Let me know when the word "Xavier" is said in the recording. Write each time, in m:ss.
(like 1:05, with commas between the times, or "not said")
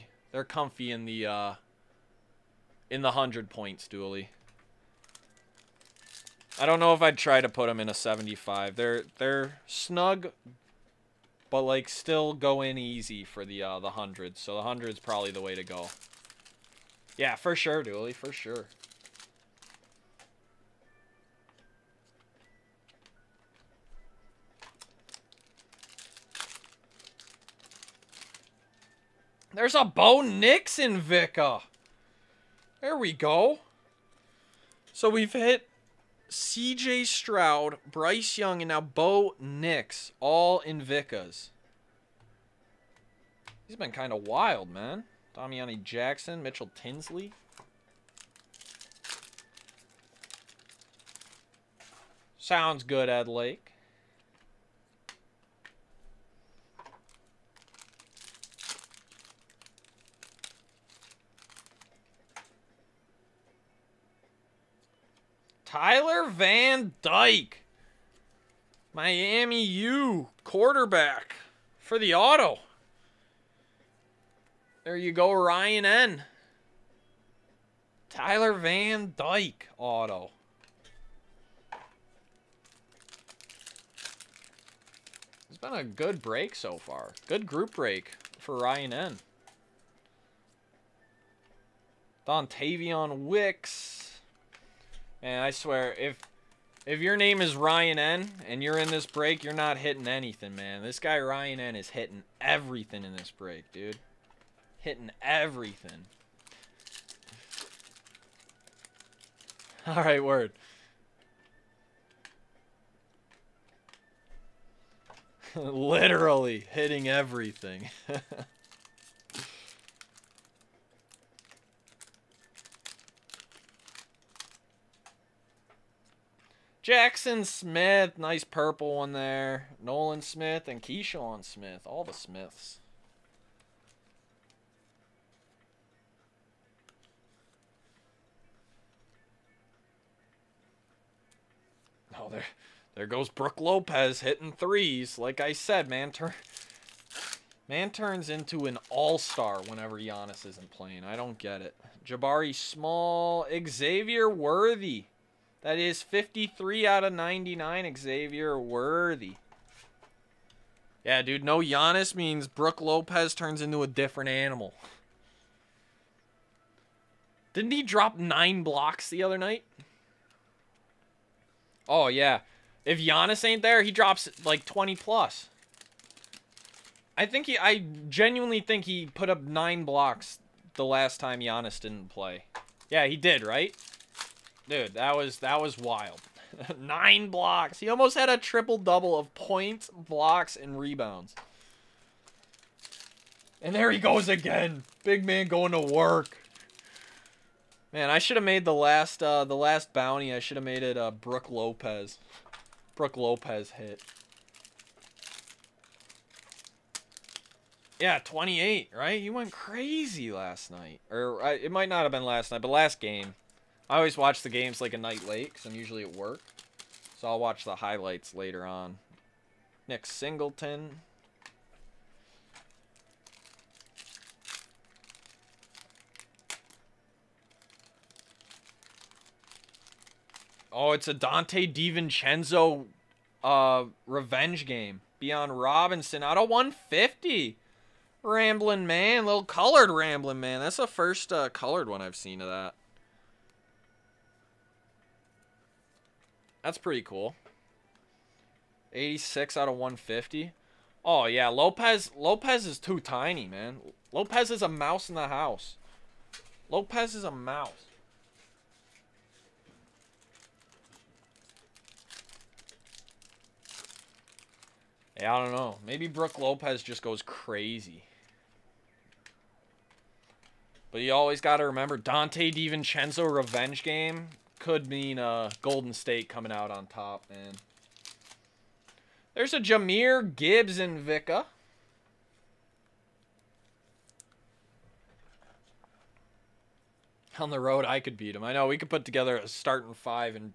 2:33, 2:37.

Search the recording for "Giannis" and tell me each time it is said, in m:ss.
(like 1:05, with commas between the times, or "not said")
2:29, 2:41, 2:52, 3:01.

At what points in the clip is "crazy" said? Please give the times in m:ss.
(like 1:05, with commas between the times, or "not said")
3:29, 4:27.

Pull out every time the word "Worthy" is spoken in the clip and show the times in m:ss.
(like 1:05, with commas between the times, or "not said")
2:34, 2:38.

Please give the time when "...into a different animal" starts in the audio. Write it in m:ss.
2:43.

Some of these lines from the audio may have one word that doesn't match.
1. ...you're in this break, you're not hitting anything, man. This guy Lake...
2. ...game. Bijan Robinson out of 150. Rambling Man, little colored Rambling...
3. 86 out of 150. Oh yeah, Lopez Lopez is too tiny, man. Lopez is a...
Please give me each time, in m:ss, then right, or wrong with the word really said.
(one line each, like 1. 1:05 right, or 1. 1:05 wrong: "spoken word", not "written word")
1. 1:38 wrong: "Ryan", not "Lake"
2. 3:54 right
3. 4:08 right.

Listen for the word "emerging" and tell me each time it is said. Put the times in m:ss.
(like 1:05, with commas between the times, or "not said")
not said.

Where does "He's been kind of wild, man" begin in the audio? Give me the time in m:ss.
0:43.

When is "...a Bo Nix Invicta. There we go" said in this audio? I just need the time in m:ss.
0:29.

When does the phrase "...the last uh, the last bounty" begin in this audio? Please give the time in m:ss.
3:18.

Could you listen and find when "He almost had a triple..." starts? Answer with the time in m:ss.
3:07.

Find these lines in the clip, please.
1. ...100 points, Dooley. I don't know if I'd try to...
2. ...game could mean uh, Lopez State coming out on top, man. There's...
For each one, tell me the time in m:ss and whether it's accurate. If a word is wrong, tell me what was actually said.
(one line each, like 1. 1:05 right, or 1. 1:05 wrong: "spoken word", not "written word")
1. 0:03 right
2. 4:33 wrong: "Golden", not "Lopez".